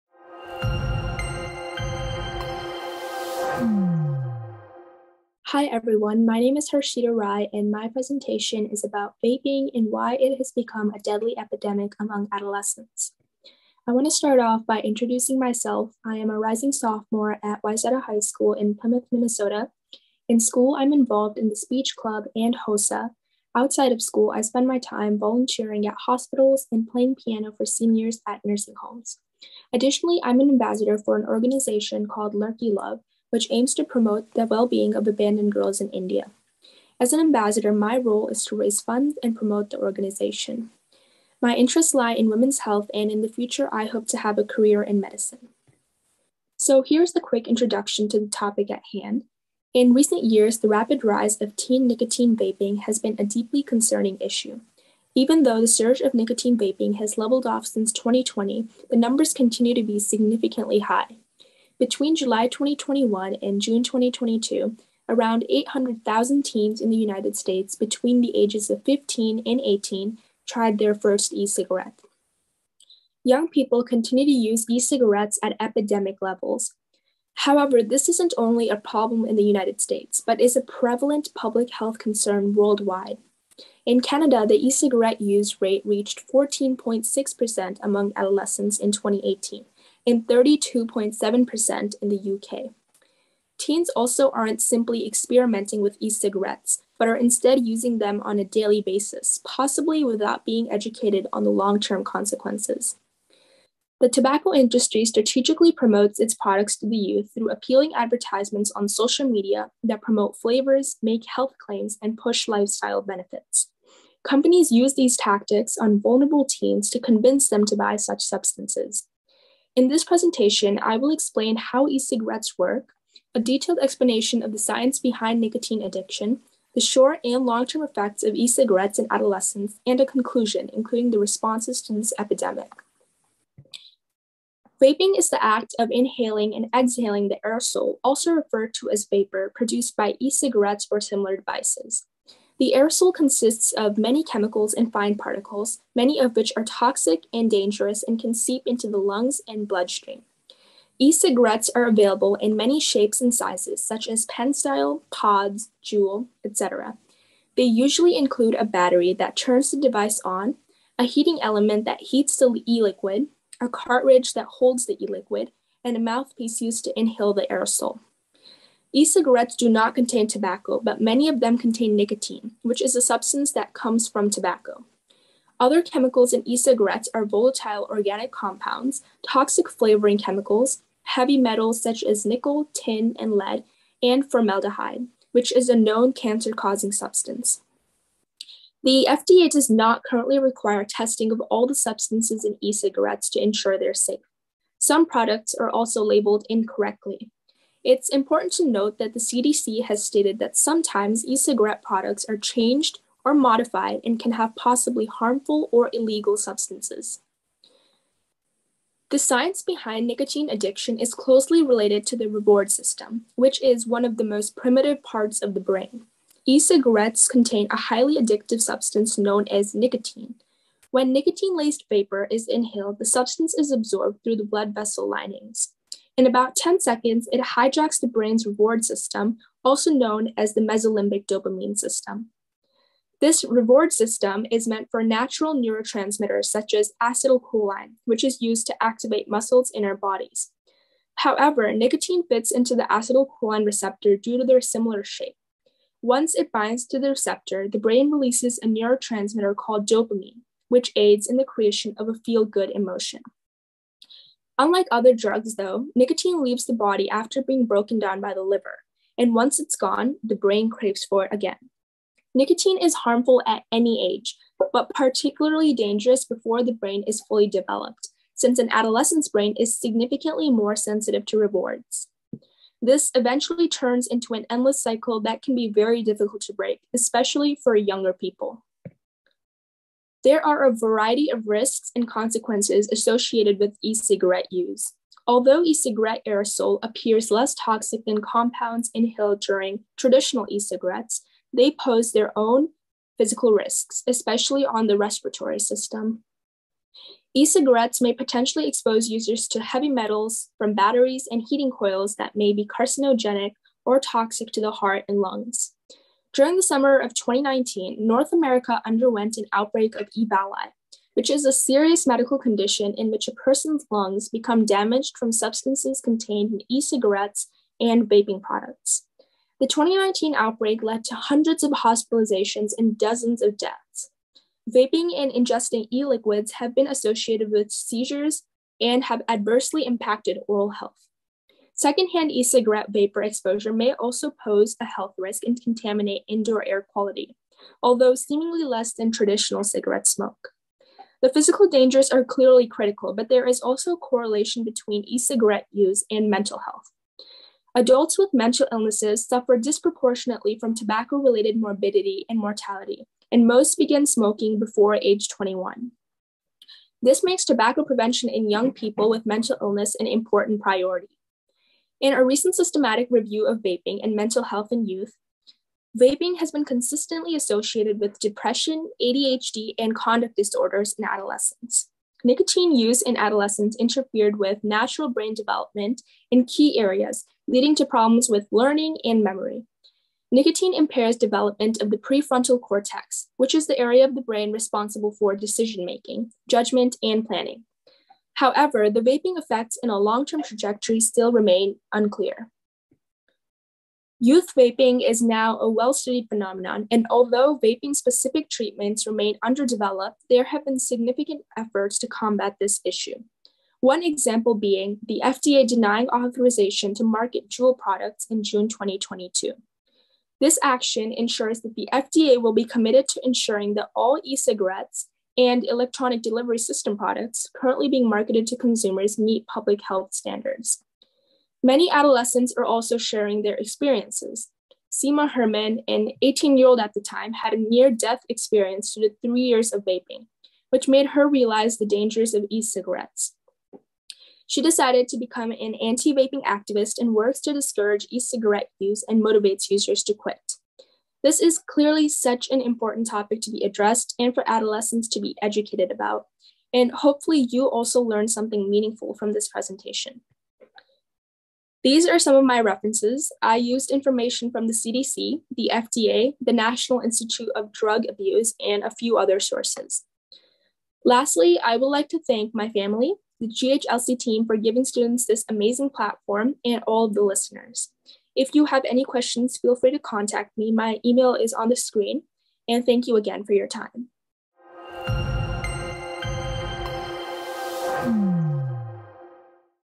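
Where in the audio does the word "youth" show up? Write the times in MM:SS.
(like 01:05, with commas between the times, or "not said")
01:46, 06:04, 06:34.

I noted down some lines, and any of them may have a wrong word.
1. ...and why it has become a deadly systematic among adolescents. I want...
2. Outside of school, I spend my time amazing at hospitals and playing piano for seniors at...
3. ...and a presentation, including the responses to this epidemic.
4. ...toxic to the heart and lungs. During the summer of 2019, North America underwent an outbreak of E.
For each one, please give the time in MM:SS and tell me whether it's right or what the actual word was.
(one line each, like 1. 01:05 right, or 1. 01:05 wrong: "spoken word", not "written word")
1. 00:09 wrong: "epidemic", not "systematic"
2. 00:23 wrong: "volunteering", not "amazing"
3. 02:09 wrong: "conclusion", not "presentation"
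4. 05:03 right.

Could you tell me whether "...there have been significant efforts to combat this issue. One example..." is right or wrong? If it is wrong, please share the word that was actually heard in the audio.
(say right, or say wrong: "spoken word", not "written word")
right.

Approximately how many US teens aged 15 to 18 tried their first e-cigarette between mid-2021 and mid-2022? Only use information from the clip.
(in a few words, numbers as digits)
800,000.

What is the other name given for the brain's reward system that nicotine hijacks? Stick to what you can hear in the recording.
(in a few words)
mesolimbic dopamine system.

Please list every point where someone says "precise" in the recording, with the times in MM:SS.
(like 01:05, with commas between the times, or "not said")
not said.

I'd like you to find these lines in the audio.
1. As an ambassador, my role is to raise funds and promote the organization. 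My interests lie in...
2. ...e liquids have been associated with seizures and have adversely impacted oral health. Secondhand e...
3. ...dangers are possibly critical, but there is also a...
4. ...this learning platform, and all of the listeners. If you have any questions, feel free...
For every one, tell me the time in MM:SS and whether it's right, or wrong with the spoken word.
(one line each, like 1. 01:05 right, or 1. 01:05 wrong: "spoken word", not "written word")
1. 00:36 right
2. 05:25 right
3. 05:41 wrong: "clearly", not "possibly"
4. 07:45 wrong: "amazing", not "learning".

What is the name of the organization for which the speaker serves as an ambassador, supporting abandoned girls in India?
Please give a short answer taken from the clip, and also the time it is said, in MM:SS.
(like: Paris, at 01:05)
Lurky Love, at 00:32.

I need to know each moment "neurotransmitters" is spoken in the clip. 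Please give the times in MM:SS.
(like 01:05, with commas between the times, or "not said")
03:55, 04:08.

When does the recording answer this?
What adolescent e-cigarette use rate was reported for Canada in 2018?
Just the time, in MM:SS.
01:26.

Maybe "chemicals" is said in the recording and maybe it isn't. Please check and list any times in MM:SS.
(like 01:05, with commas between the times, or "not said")
02:24, 02:55, 03:00.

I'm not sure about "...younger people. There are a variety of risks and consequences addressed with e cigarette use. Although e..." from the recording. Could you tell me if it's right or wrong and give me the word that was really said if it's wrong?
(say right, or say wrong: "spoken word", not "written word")
wrong: "associated", not "addressed".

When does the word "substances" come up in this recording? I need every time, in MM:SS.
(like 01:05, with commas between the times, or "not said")
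01:58, 02:53, 03:06, 03:11, 03:26, 03:38, 03:43, 05:15.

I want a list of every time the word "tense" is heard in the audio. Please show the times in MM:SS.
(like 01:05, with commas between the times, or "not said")
not said.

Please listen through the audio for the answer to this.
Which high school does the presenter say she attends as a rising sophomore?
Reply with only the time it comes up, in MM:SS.
00:17.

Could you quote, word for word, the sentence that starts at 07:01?
Many adolescents are also sharing their experiences.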